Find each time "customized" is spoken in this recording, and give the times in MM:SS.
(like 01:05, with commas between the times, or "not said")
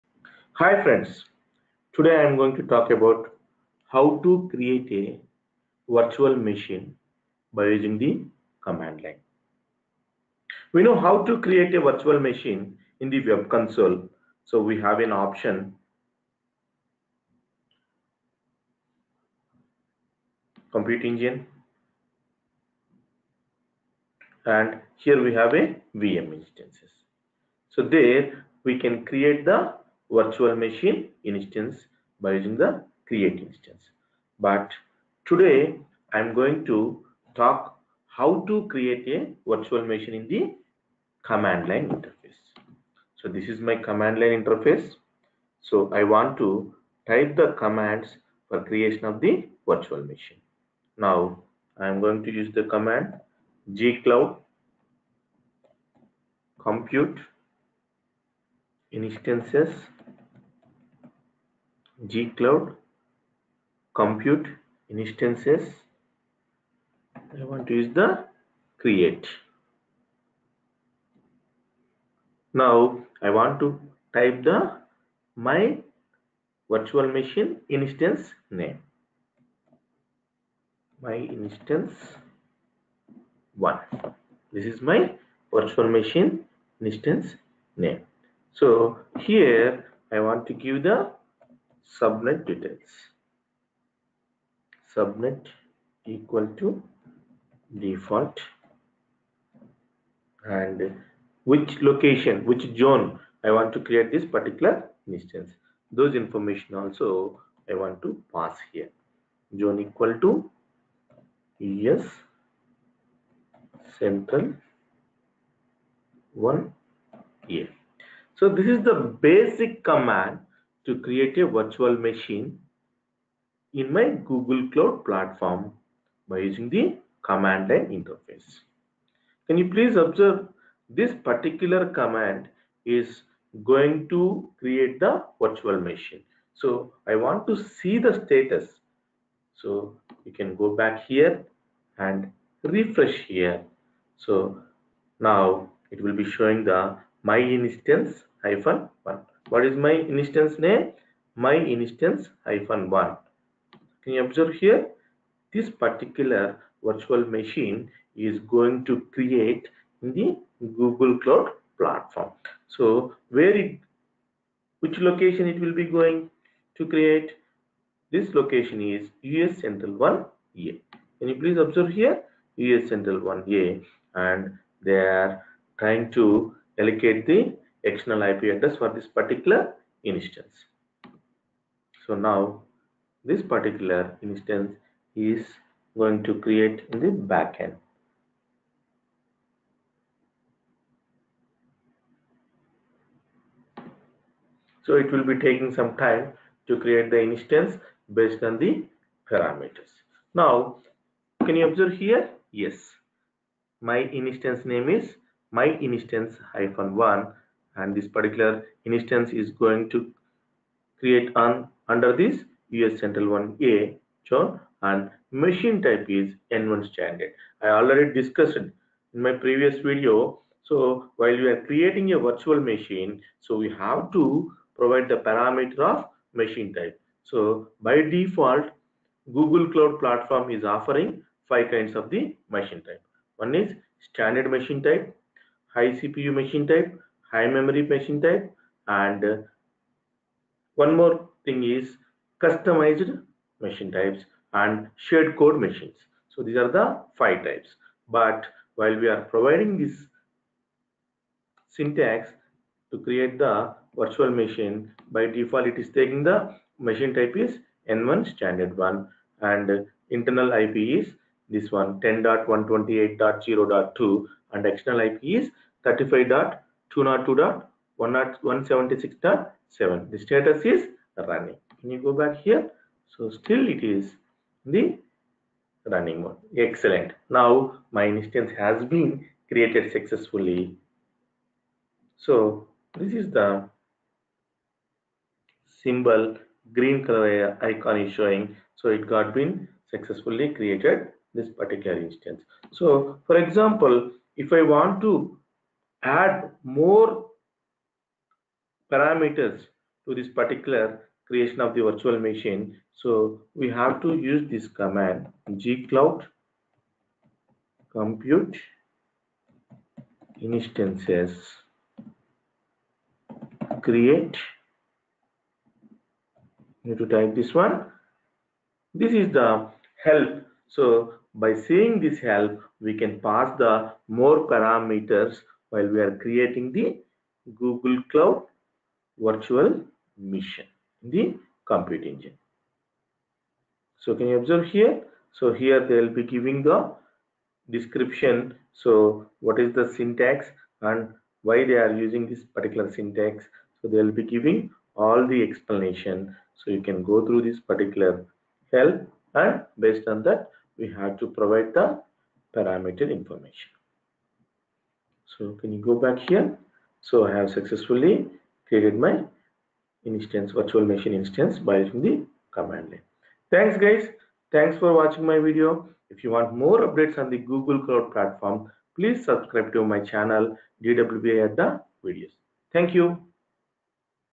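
04:02.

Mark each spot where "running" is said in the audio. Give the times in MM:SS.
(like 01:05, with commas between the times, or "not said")
04:31, 04:35.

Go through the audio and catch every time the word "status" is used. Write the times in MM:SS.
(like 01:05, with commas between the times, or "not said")
02:18, 04:30.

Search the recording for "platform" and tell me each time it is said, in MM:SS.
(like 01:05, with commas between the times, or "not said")
02:05, 02:41, 03:49, 06:08.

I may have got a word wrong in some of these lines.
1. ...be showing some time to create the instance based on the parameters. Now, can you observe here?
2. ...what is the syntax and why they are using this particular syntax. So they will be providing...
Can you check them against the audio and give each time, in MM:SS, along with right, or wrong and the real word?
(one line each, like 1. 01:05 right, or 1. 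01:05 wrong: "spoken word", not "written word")
1. 03:15 wrong: "taking", not "showing"
2. 05:39 wrong: "giving", not "providing".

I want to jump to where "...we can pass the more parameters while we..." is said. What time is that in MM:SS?
05:22.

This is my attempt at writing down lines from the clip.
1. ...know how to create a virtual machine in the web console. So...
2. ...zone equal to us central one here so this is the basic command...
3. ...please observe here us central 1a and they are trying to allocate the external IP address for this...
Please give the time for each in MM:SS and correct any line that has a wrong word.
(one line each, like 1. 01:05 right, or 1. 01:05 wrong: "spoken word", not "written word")
1. 00:10 right
2. 01:49 right
3. 02:51 right.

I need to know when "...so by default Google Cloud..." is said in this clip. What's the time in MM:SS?
03:47.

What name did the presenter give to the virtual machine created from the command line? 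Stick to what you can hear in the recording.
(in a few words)
my-instance-1.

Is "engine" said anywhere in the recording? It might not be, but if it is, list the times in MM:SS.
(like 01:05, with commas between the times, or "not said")
00:21, 05:32.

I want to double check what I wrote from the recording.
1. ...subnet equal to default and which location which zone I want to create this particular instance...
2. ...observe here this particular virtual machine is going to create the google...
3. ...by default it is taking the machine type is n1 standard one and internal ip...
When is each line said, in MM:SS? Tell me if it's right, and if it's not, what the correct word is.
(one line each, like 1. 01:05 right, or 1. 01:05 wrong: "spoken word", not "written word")
1. 01:34 right
2. 02:34 right
3. 04:15 right.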